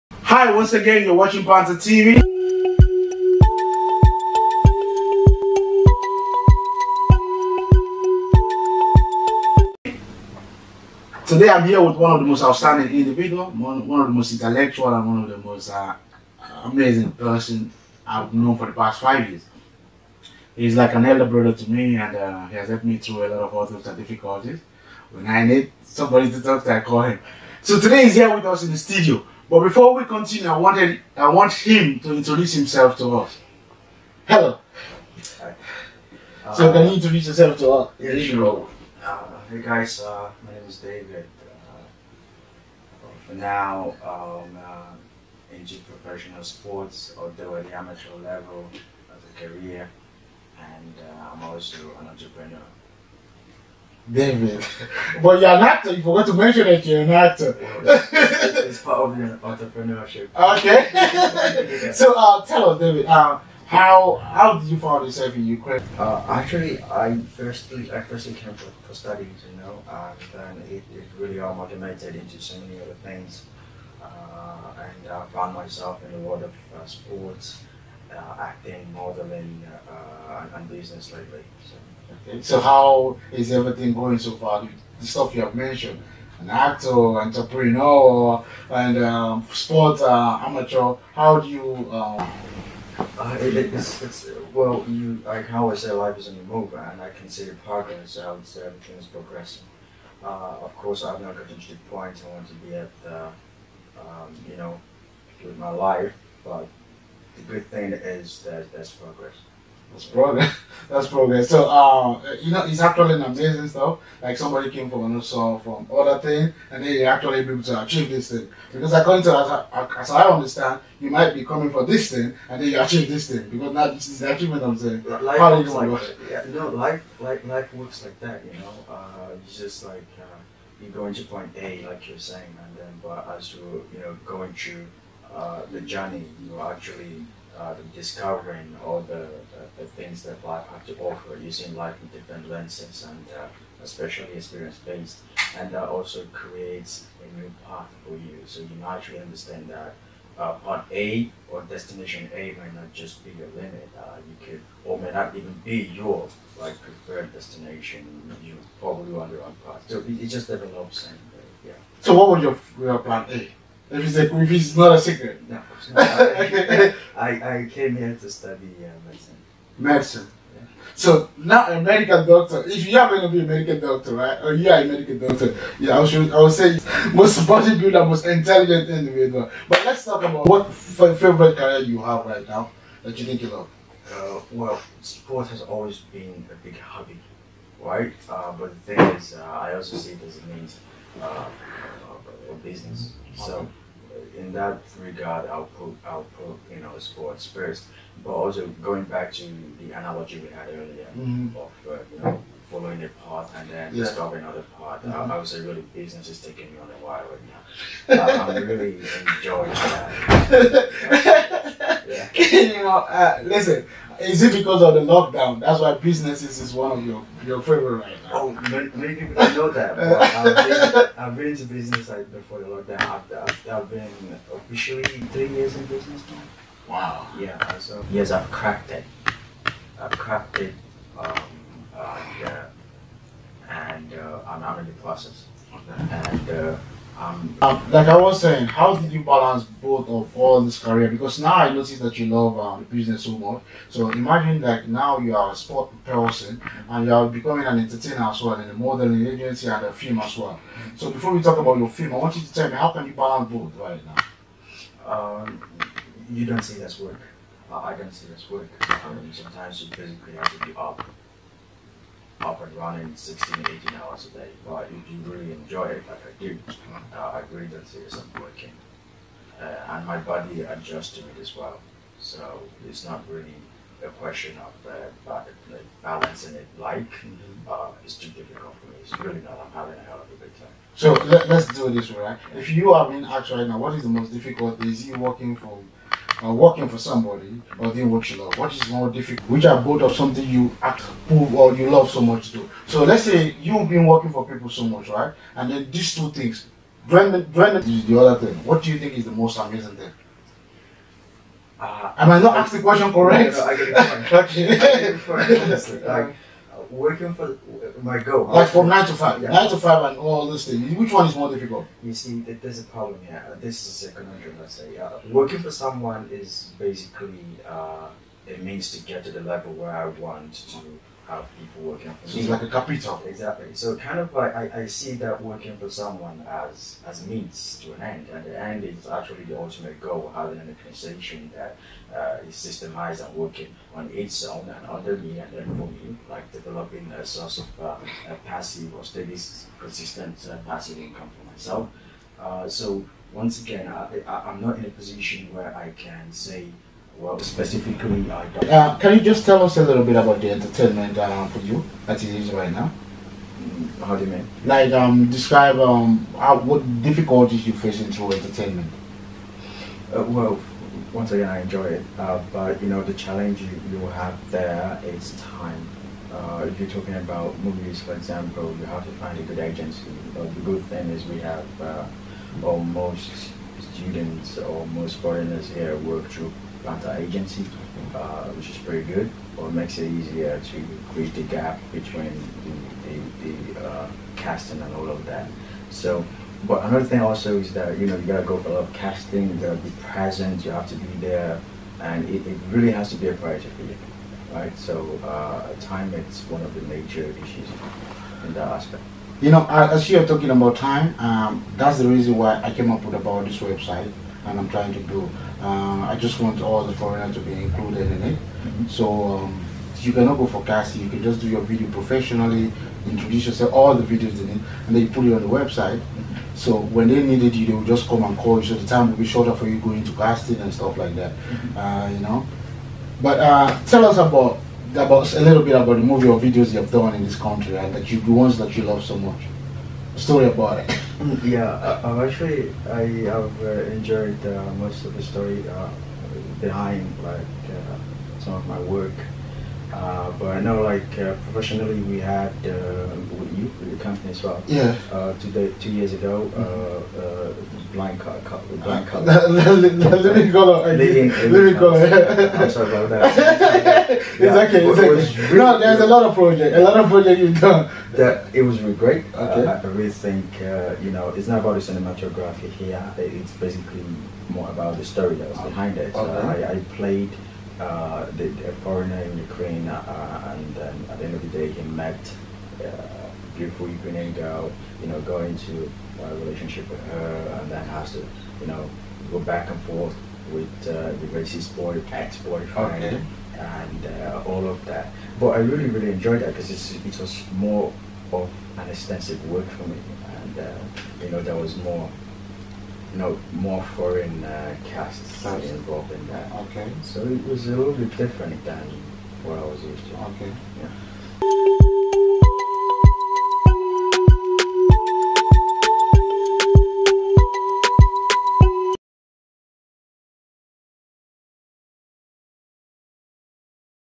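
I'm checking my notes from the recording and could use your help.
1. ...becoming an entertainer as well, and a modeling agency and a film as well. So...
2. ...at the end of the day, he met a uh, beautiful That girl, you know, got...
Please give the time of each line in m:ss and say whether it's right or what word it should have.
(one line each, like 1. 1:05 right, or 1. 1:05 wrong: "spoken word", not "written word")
1. 4:07 right
2. 7:51 wrong: "Ukrainian", not "That".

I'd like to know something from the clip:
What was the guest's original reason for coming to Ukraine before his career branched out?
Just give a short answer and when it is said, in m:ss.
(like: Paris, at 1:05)
Studies, at 1:08.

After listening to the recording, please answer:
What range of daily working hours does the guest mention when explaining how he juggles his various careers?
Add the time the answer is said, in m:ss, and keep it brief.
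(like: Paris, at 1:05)
16 to 18 hours, at 4:23.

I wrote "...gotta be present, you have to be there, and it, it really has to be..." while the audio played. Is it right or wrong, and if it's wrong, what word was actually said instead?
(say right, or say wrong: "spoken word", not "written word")
right.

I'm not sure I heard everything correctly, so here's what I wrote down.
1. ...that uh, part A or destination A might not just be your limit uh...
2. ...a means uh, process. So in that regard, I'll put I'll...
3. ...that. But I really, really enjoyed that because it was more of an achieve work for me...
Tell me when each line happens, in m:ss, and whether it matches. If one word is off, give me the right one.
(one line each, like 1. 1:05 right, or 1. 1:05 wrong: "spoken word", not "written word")
1. 2:29 right
2. 3:10 wrong: "business", not "process"
3. 8:04 wrong: "extensive", not "achieve".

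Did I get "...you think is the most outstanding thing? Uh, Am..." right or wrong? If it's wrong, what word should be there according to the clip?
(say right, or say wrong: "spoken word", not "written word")
wrong: "amazing", not "outstanding".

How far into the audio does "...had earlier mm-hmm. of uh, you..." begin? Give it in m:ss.
3:20.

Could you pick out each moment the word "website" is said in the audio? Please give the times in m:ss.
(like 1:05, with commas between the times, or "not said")
6:43, 6:55.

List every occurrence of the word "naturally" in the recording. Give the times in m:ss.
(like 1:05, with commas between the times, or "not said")
2:28.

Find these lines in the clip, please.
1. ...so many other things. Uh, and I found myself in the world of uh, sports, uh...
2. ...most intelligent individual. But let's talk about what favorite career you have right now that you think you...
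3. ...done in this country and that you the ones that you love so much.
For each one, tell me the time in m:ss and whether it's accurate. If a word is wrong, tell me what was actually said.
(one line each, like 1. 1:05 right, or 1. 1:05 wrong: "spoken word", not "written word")
1. 1:12 right
2. 2:58 right
3. 7:06 right.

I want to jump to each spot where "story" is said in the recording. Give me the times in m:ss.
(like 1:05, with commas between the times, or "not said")
7:10, 7:15, 7:45.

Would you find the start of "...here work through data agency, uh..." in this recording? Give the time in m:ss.
6:15.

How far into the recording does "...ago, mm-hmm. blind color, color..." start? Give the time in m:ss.
7:26.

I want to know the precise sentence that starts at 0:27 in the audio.
So today he's here with us in the studio.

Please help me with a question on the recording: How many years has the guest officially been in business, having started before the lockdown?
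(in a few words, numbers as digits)
3.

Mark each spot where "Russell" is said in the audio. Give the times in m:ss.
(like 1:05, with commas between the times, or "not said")
not said.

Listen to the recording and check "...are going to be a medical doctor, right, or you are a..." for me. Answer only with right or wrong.
right.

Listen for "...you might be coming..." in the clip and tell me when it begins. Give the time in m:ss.
2:00.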